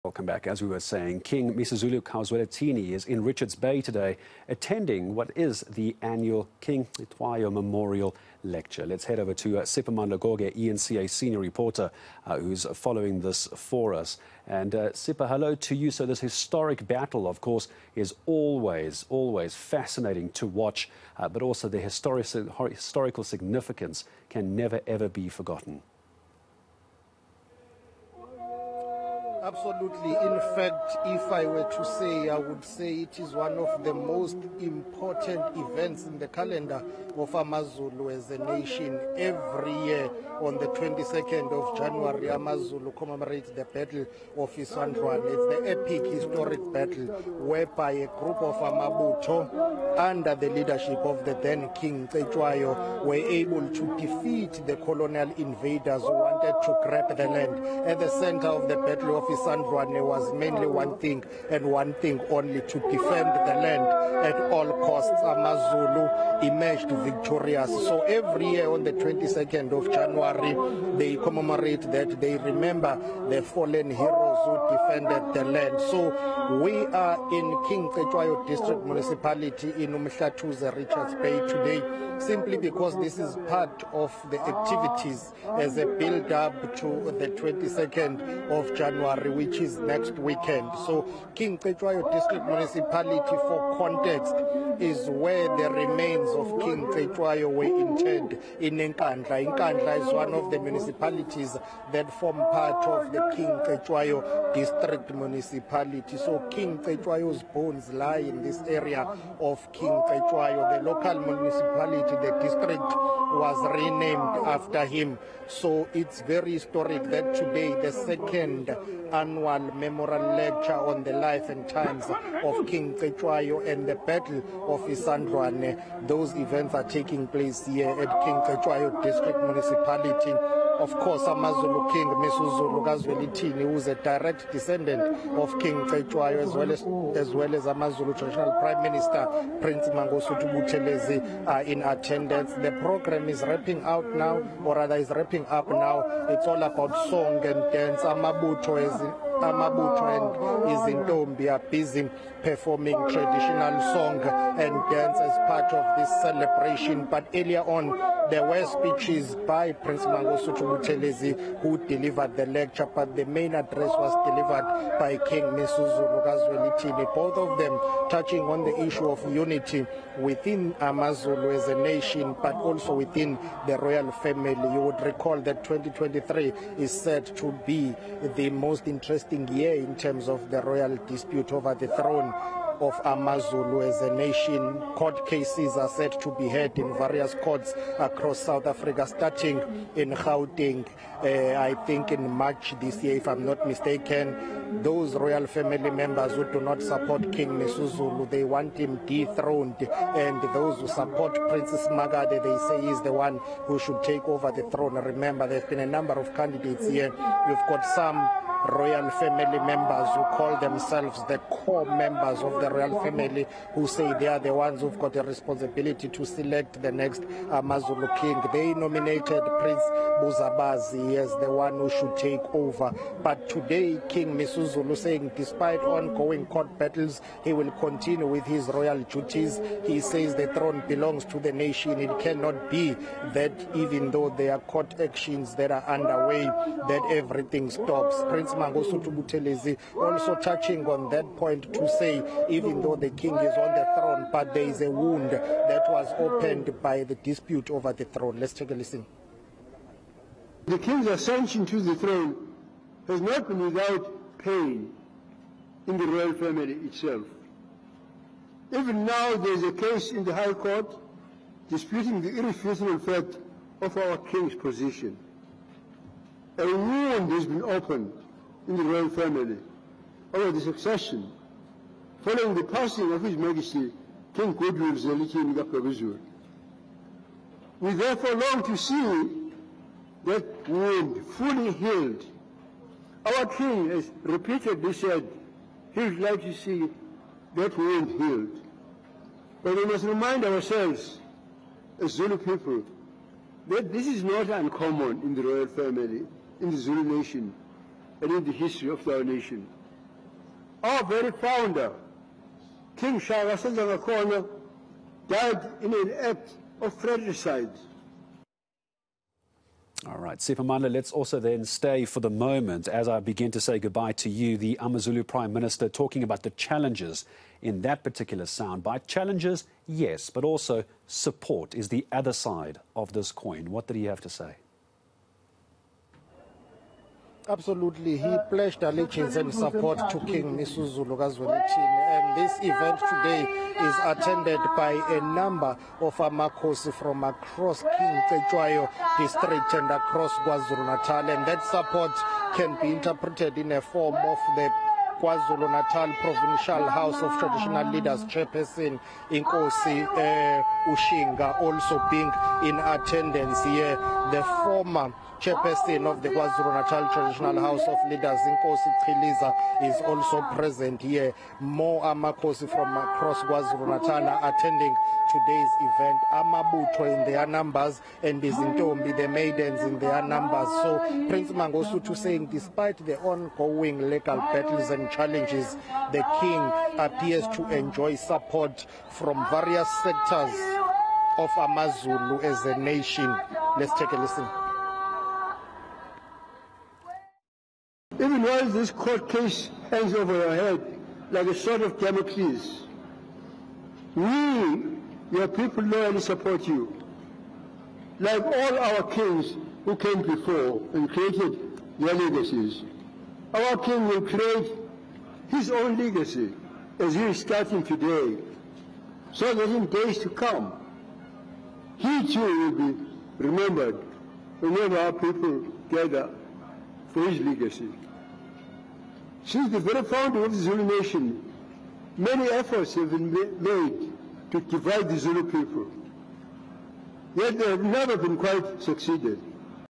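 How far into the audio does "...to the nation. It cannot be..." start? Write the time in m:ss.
3:51.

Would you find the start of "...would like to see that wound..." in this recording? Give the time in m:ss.
4:46.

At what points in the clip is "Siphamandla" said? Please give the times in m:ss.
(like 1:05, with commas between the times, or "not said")
0:09, 5:10.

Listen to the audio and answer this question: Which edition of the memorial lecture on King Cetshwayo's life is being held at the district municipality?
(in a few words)
second.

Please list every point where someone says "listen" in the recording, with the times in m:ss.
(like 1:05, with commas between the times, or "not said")
4:08, 6:24.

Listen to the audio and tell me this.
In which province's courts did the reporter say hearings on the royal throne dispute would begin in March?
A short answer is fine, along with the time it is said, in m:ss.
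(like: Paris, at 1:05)
Gauteng, at 3:10.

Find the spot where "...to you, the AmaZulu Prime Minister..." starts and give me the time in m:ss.
5:14.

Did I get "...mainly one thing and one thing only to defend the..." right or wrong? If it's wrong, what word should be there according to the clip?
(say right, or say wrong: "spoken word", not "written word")
right.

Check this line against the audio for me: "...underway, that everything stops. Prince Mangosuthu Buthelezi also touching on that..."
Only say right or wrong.
right.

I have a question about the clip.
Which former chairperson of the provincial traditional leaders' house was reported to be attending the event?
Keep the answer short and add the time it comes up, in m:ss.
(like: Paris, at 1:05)
Inkosi Chiliza, at 5:58.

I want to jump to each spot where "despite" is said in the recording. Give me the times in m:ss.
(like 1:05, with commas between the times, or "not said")
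3:45, 6:12.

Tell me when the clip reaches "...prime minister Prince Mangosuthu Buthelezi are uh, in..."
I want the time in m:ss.
2:18.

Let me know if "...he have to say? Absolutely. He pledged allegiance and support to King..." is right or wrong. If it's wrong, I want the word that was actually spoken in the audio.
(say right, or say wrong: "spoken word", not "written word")
right.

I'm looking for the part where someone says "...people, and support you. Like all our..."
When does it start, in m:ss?
6:35.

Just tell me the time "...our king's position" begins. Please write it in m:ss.
4:23.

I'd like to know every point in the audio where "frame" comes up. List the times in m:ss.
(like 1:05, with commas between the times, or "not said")
not said.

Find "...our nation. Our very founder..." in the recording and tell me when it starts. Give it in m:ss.
4:59.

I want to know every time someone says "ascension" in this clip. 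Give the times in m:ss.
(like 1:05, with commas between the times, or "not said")
4:11.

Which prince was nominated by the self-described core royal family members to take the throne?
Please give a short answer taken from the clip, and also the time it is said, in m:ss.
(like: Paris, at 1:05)
Prince Buzabazi, at 3:39.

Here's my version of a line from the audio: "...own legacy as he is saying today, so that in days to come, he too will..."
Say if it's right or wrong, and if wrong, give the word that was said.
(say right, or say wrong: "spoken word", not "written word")
wrong: "starting", not "saying".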